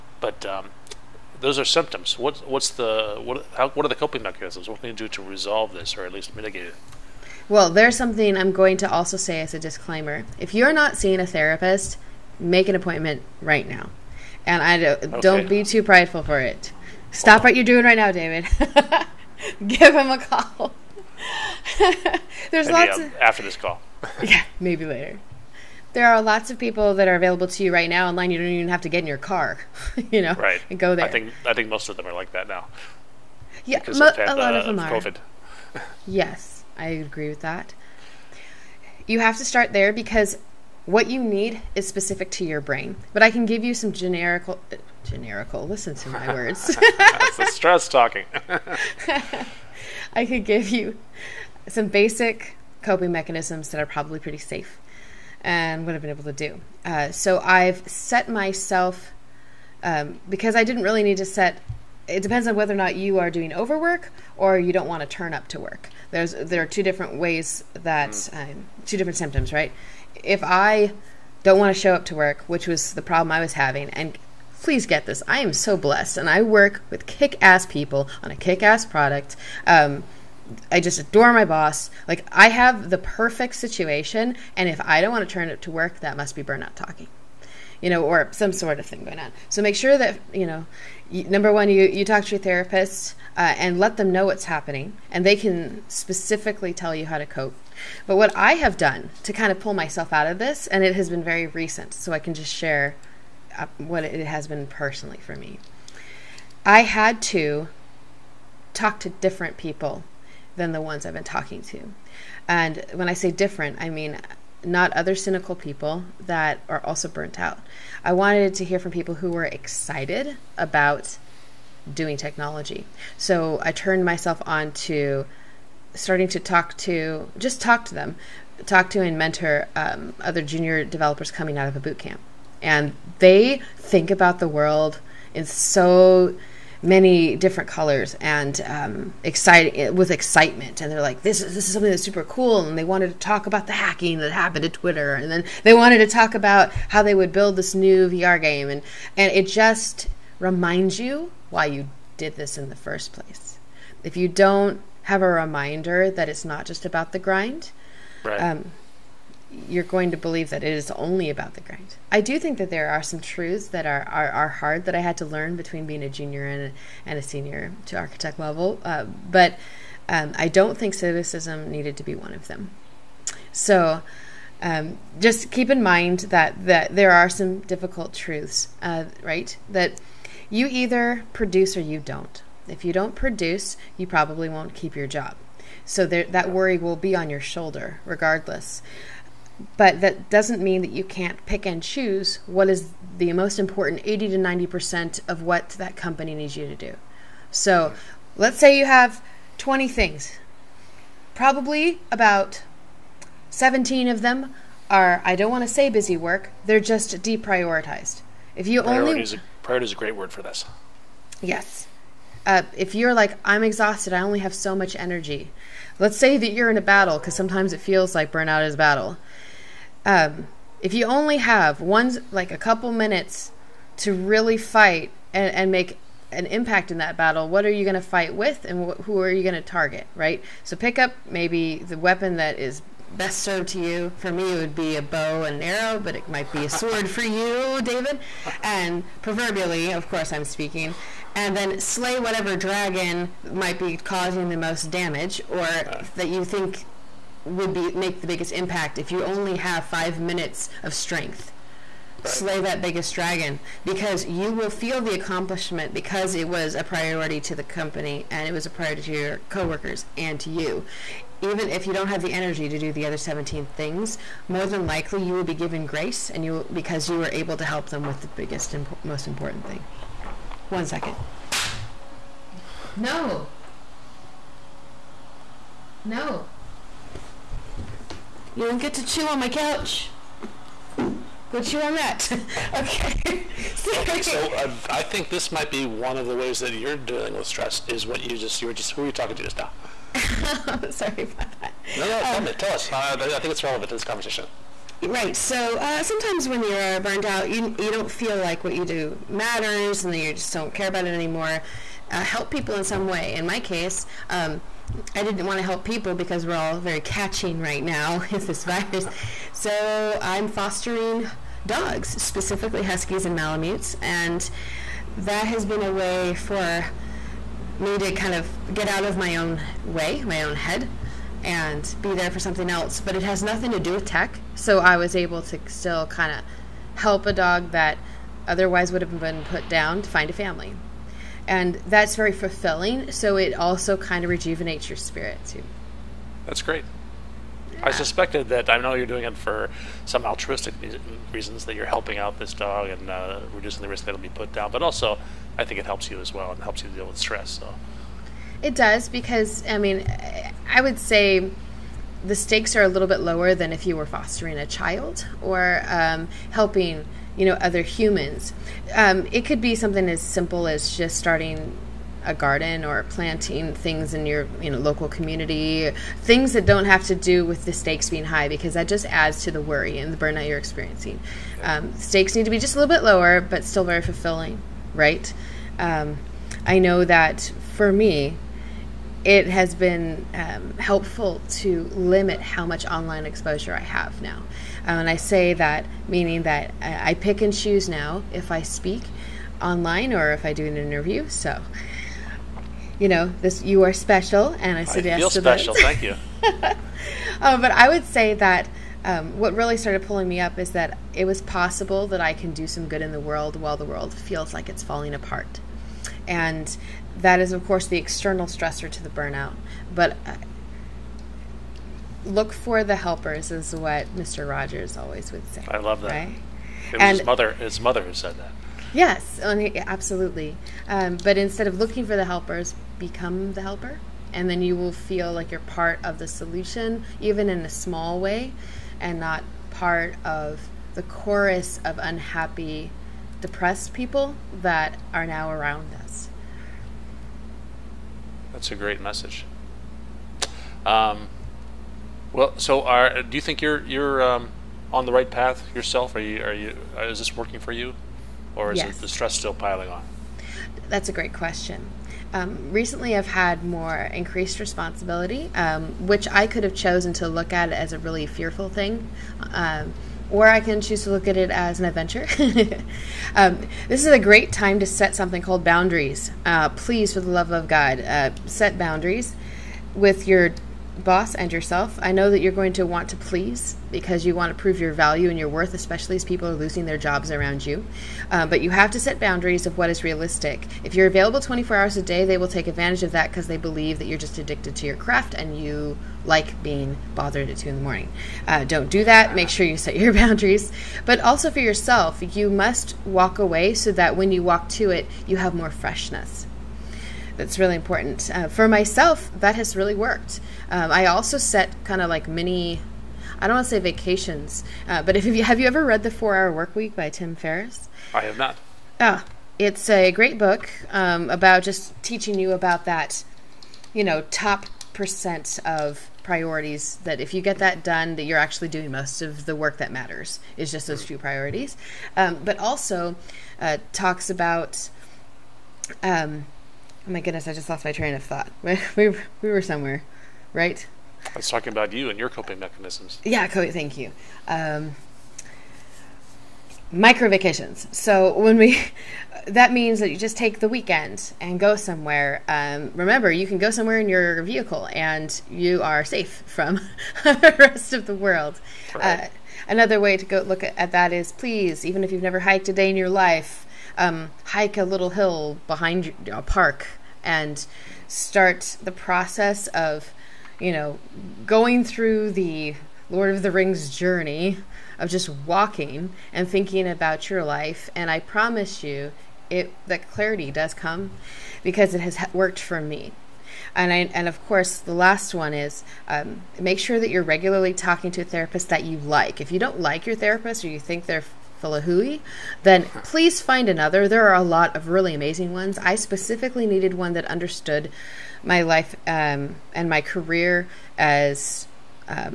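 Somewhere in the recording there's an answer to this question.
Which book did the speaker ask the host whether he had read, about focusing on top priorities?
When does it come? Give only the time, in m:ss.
8:26.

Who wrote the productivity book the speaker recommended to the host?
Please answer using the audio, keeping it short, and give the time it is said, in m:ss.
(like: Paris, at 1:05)
Tim Ferriss, at 8:27.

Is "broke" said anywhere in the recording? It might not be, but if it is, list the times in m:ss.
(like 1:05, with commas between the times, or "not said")
not said.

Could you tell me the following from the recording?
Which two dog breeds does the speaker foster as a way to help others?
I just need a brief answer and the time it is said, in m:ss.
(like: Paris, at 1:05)
Huskies and Malamutes, at 5:12.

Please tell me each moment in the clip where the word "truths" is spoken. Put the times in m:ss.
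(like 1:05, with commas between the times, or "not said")
2:43, 2:58.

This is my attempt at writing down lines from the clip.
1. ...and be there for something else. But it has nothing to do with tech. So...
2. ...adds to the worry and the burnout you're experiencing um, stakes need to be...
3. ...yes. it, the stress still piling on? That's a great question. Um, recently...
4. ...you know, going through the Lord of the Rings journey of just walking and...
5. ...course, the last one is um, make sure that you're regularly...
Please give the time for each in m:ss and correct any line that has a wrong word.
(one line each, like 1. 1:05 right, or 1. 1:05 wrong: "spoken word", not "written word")
1. 5:21 right
2. 6:09 right
3. 7:28 right
4. 9:20 right
5. 9:34 right.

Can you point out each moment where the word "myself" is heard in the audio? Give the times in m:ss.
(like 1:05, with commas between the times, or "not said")
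0:58, 1:39, 2:04, 8:18.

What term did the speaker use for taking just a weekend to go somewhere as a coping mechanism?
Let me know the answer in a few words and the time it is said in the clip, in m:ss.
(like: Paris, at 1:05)
Micro vacations, at 8:56.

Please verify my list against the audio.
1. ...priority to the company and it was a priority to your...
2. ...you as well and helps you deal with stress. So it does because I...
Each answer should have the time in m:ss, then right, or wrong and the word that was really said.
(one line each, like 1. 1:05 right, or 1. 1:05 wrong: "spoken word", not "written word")
1. 4:16 right
2. 5:46 right.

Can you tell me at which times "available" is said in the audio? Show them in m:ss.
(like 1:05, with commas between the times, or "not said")
0:27, 8:01.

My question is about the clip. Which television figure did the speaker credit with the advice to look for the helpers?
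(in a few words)
Mr. Rogers.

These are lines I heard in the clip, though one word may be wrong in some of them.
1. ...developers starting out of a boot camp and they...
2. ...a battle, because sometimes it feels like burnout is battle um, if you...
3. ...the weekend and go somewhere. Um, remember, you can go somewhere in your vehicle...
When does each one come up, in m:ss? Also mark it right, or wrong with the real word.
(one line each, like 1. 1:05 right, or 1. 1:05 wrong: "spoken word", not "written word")
1. 2:10 wrong: "coming", not "starting"
2. 3:36 right
3. 9:00 right.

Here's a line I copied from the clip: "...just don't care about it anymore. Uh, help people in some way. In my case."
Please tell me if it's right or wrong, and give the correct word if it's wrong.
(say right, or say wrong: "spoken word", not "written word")
right.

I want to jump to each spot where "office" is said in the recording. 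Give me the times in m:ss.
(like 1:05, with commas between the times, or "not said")
not said.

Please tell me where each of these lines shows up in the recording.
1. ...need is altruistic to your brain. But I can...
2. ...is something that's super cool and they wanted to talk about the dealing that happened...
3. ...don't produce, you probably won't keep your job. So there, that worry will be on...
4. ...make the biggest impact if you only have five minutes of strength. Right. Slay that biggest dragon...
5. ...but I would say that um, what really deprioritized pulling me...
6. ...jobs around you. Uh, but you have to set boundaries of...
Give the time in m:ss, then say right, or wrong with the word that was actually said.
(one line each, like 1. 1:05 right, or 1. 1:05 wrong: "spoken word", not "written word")
1. 0:41 wrong: "specific", not "altruistic"
2. 2:21 wrong: "hacking", not "dealing"
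3. 3:02 right
4. 4:07 right
5. 6:37 wrong: "started", not "deprioritized"
6. 7:56 right.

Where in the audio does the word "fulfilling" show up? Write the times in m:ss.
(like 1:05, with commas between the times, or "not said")
5:32, 6:14.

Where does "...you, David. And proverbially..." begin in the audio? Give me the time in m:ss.
3:57.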